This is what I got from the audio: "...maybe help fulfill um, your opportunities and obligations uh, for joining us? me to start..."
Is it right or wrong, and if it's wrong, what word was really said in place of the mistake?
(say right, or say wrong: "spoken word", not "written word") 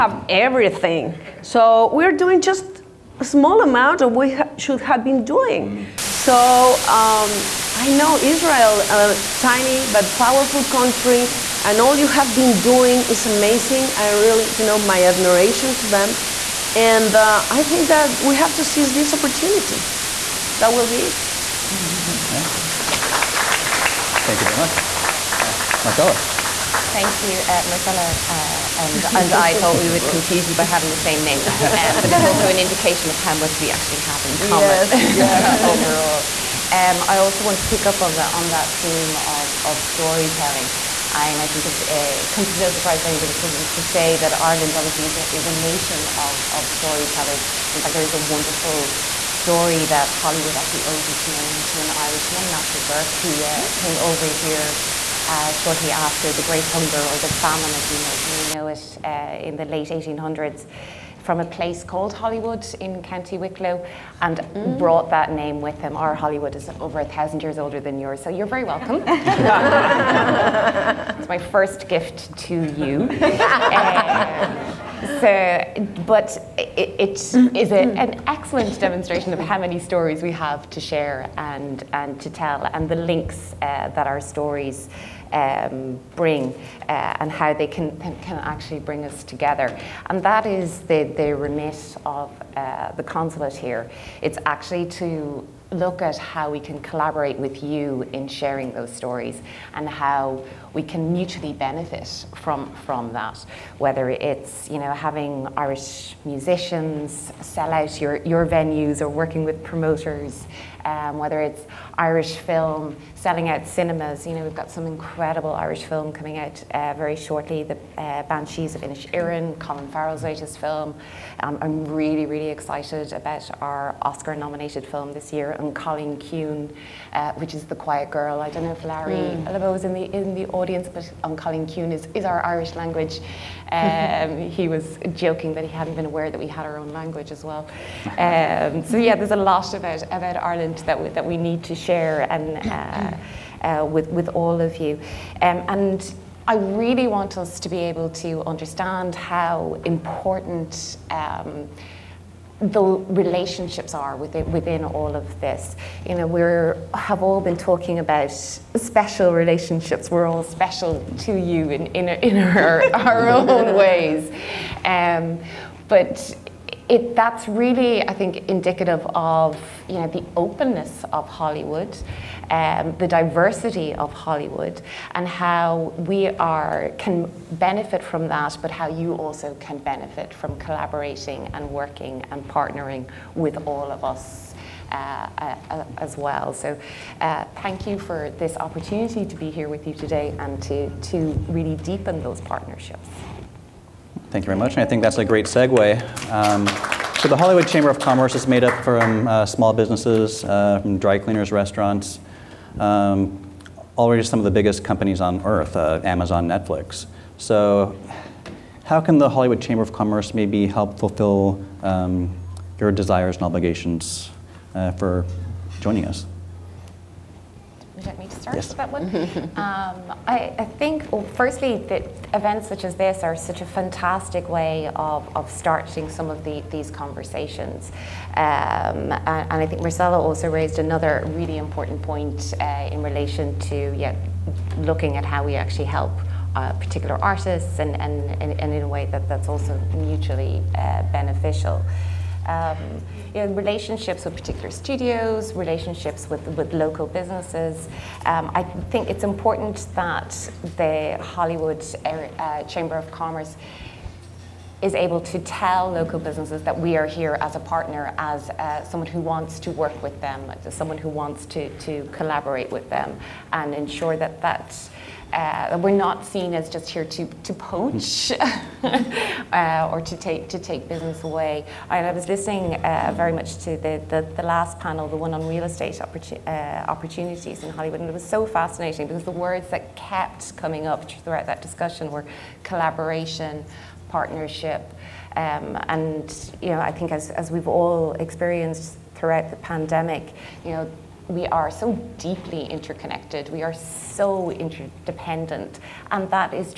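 wrong: "desires", not "opportunities".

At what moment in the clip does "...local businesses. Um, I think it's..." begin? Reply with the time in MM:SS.
04:06.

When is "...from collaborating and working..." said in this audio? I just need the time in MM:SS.
03:00.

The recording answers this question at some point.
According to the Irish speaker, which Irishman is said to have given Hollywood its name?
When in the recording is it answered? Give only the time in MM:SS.
00:52.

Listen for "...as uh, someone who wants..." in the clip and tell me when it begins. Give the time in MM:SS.
04:18.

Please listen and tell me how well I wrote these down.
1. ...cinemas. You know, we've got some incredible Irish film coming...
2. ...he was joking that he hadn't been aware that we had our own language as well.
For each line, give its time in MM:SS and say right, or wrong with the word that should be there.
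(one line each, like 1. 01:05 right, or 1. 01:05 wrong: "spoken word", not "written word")
1. 01:53 right
2. 02:14 right.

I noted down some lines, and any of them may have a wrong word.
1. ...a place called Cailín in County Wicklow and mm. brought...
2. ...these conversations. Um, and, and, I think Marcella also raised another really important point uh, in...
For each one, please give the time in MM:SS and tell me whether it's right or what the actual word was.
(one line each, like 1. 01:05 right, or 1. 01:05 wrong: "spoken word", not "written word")
1. 01:01 wrong: "Hollywood", not "Cailín"
2. 03:46 right.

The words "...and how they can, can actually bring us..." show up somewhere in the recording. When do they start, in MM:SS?
01:27.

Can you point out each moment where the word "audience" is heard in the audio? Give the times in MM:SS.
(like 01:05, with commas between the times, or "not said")
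02:10.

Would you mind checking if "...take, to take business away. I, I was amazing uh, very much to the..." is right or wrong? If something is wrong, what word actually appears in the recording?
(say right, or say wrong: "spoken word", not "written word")
wrong: "listening", not "amazing".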